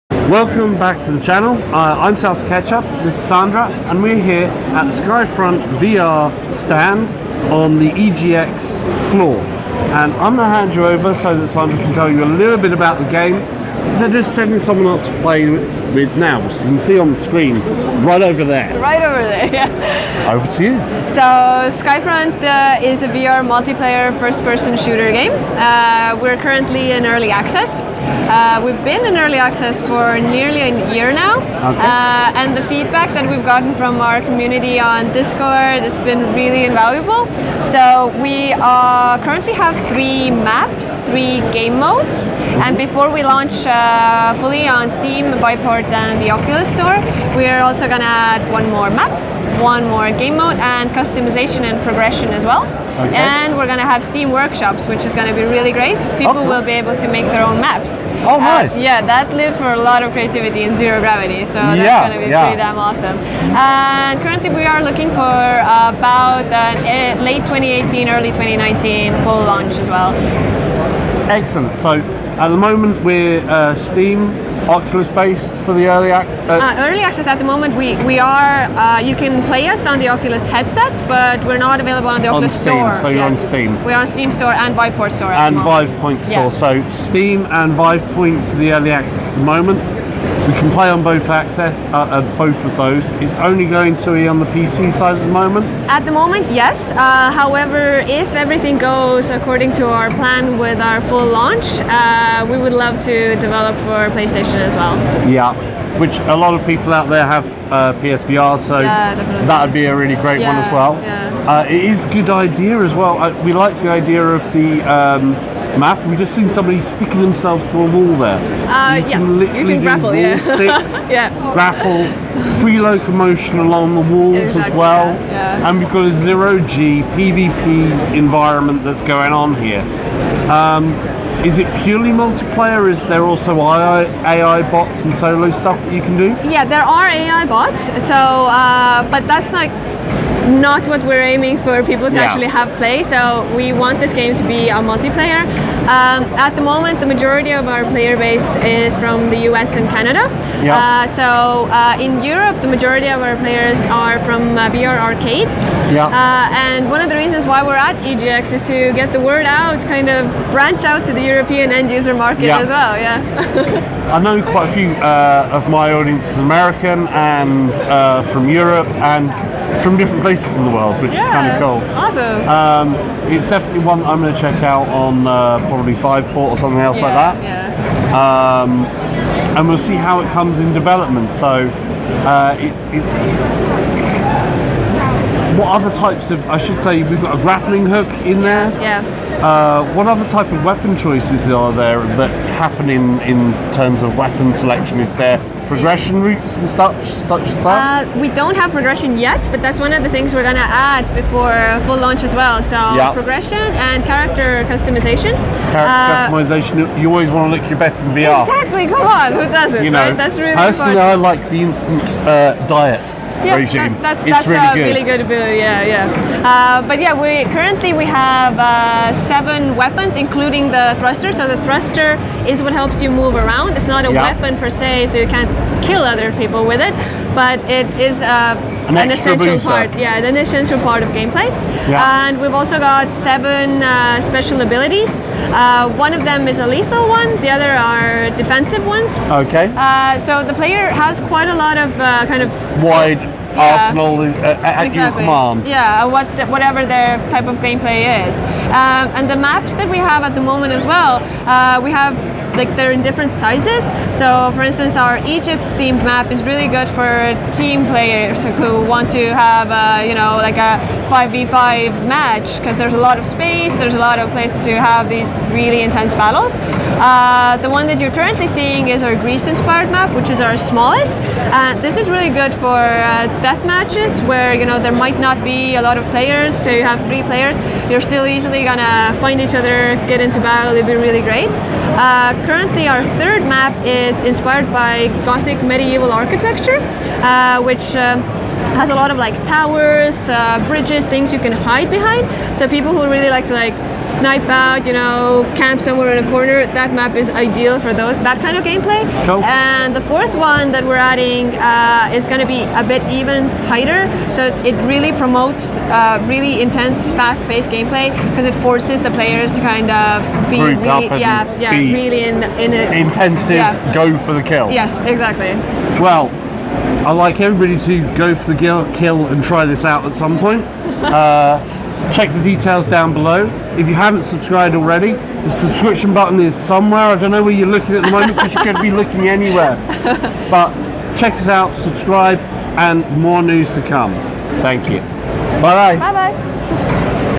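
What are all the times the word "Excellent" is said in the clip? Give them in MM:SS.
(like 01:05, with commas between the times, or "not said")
01:11.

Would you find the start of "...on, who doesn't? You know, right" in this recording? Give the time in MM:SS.
03:29.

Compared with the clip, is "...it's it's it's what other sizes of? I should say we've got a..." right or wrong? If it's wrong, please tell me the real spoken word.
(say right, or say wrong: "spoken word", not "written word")
wrong: "types", not "sizes".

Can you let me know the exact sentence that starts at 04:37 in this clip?
You're still easily gonna find each other, get into battle.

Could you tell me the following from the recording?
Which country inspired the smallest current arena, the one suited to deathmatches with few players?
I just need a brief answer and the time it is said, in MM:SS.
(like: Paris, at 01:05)
Greece, at 04:29.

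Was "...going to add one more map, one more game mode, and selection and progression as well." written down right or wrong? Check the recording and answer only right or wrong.
wrong.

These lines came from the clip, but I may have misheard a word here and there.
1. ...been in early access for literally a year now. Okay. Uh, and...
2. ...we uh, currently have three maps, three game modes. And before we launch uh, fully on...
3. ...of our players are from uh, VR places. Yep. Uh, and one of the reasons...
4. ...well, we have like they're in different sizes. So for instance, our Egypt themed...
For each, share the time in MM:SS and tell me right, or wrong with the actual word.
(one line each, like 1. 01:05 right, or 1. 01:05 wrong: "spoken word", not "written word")
1. 00:28 wrong: "nearly", not "literally"
2. 00:38 right
3. 02:33 wrong: "arcades", not "places"
4. 04:10 right.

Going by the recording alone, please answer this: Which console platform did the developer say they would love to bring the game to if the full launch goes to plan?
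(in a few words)
PlayStation.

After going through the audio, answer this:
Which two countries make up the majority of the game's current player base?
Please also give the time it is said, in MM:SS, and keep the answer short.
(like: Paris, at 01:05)
US and Canada, at 02:29.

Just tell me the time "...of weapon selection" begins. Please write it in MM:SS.
03:14.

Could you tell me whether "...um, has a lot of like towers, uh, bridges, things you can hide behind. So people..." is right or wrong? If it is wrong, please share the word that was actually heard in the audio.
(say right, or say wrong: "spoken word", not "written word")
right.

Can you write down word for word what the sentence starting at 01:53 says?
Uh, we like the idea of the um, Math, we've just seen somebody sticking themselves to a wall there.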